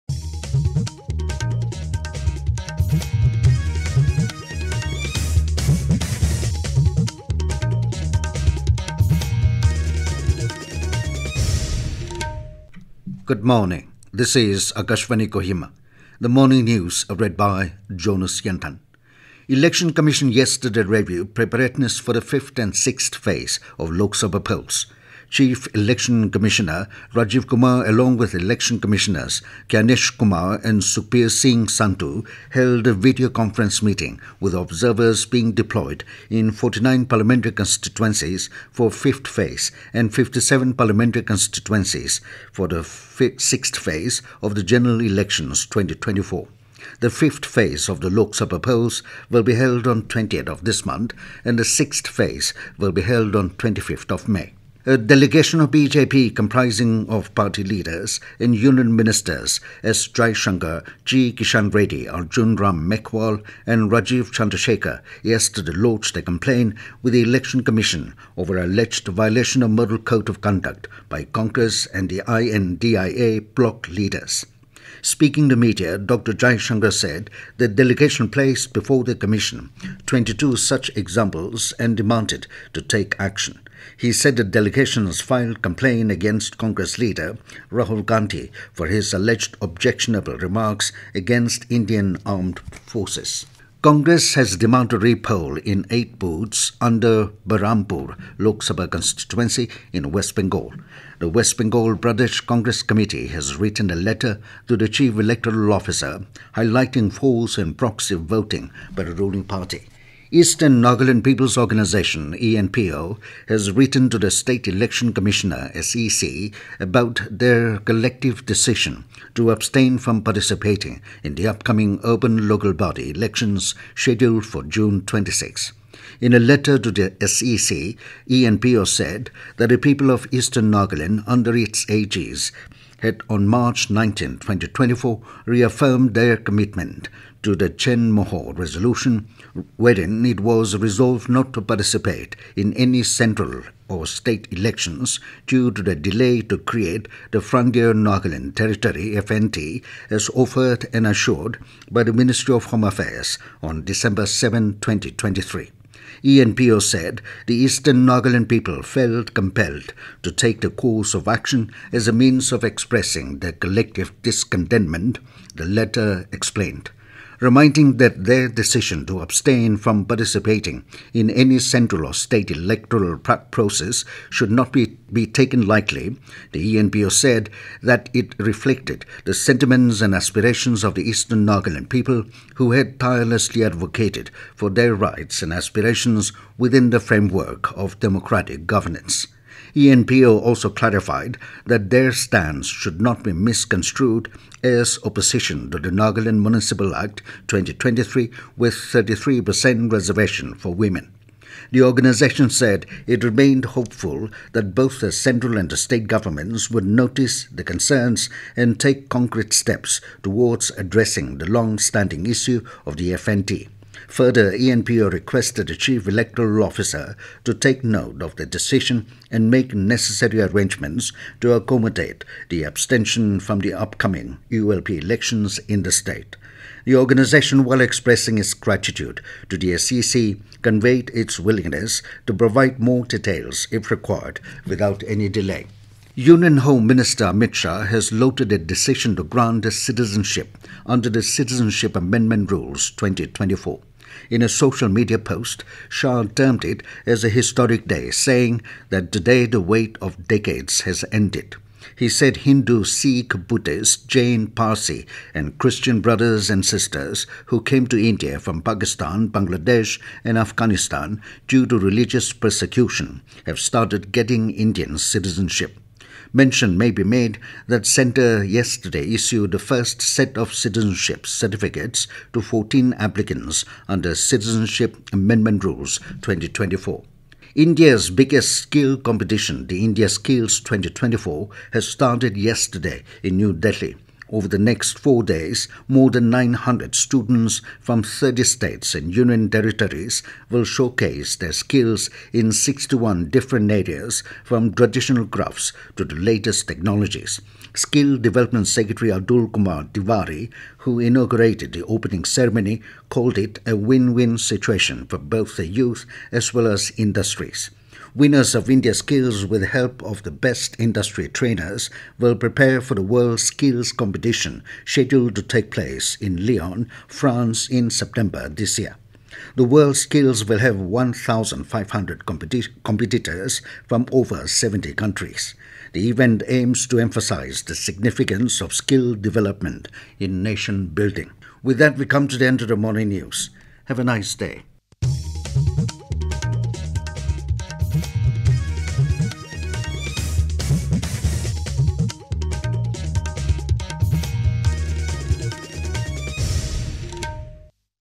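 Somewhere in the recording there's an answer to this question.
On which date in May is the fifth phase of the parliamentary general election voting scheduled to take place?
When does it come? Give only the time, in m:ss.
0:50.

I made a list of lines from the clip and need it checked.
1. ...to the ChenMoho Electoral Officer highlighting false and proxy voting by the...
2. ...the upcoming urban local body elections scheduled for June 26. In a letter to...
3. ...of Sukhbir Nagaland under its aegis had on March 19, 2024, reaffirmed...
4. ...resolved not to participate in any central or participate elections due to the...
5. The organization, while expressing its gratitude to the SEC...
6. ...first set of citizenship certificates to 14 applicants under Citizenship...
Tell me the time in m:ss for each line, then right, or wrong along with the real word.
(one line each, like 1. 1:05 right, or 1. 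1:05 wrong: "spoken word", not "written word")
1. 1:44 wrong: "Chief", not "ChenMoho"
2. 2:01 right
3. 2:10 wrong: "Eastern", not "Sukhbir"
4. 2:20 wrong: "state", not "participate"
5. 3:46 right
6. 4:29 right.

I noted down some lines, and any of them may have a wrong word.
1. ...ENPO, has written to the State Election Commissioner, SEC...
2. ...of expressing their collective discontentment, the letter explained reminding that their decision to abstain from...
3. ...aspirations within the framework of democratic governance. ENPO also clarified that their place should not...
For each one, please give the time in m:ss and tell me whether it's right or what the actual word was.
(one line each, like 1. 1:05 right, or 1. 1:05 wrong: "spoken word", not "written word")
1. 1:52 right
2. 2:42 right
3. 3:05 wrong: "stance", not "place".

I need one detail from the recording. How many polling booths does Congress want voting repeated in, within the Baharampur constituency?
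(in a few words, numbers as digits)
8.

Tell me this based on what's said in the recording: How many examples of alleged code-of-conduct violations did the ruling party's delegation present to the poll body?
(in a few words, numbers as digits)
22.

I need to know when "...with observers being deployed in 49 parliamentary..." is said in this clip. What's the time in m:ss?
0:34.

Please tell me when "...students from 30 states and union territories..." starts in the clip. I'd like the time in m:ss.
4:46.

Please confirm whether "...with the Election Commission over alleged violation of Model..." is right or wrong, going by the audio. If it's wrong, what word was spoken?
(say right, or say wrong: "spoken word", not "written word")
right.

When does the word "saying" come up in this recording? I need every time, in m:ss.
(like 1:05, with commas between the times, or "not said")
4:08.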